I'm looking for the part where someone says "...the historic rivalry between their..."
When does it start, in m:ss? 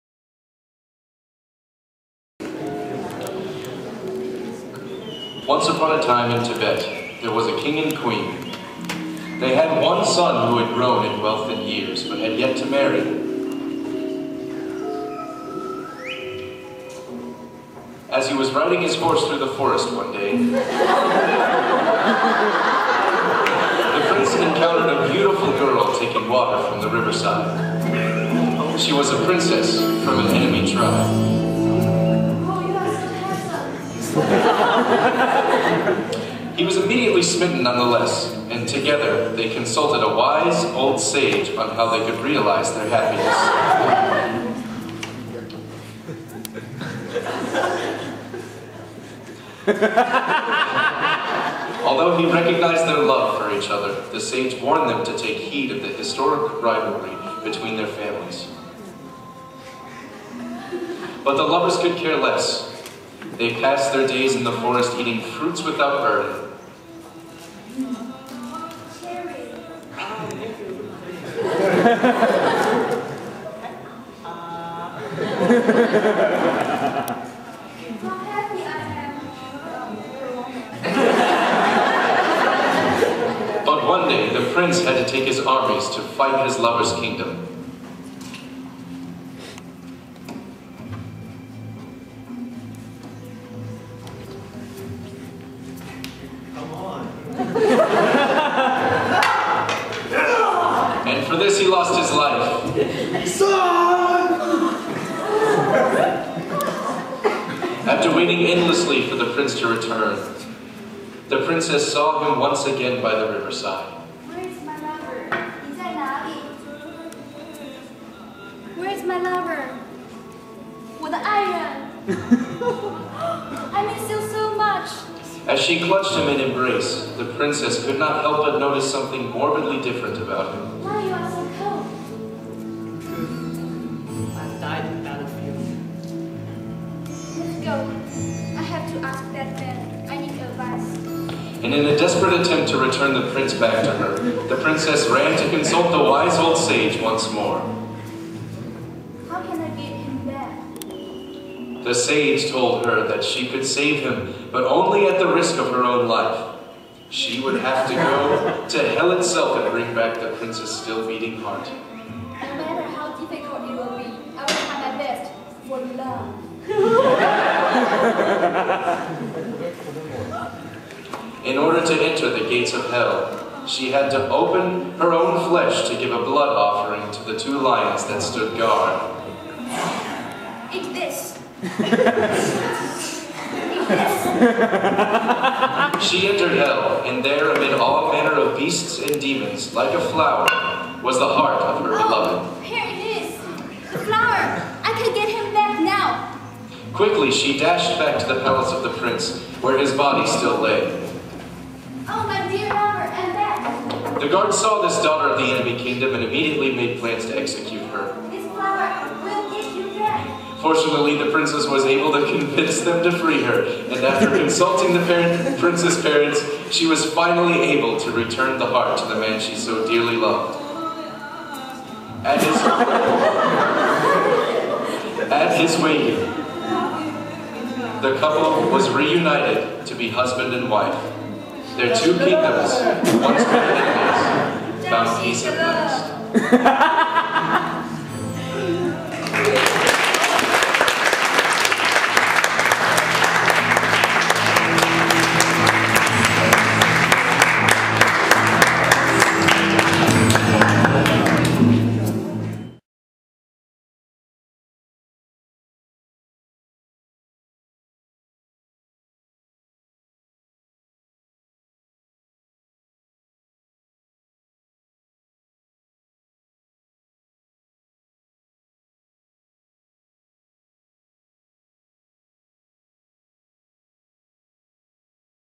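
0:55.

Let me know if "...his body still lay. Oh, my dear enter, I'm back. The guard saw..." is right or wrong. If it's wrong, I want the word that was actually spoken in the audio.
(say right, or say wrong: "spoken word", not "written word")
wrong: "lover", not "enter".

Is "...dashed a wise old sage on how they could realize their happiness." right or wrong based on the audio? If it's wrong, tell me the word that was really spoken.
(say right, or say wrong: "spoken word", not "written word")
wrong: "consulted", not "dashed".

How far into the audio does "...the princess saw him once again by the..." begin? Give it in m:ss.
1:51.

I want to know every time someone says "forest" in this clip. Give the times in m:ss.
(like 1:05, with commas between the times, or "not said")
0:19, 1:04.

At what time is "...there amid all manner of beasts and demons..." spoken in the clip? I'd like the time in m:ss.
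3:07.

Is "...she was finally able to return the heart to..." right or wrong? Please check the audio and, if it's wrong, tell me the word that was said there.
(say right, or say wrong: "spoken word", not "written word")
right.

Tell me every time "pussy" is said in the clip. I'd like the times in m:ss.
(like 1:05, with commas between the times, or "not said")
not said.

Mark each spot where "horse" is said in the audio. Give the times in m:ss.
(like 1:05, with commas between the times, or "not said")
0:18.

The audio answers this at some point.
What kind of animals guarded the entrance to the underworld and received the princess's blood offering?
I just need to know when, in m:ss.
2:57.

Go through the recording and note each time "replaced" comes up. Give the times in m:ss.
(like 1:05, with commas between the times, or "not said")
not said.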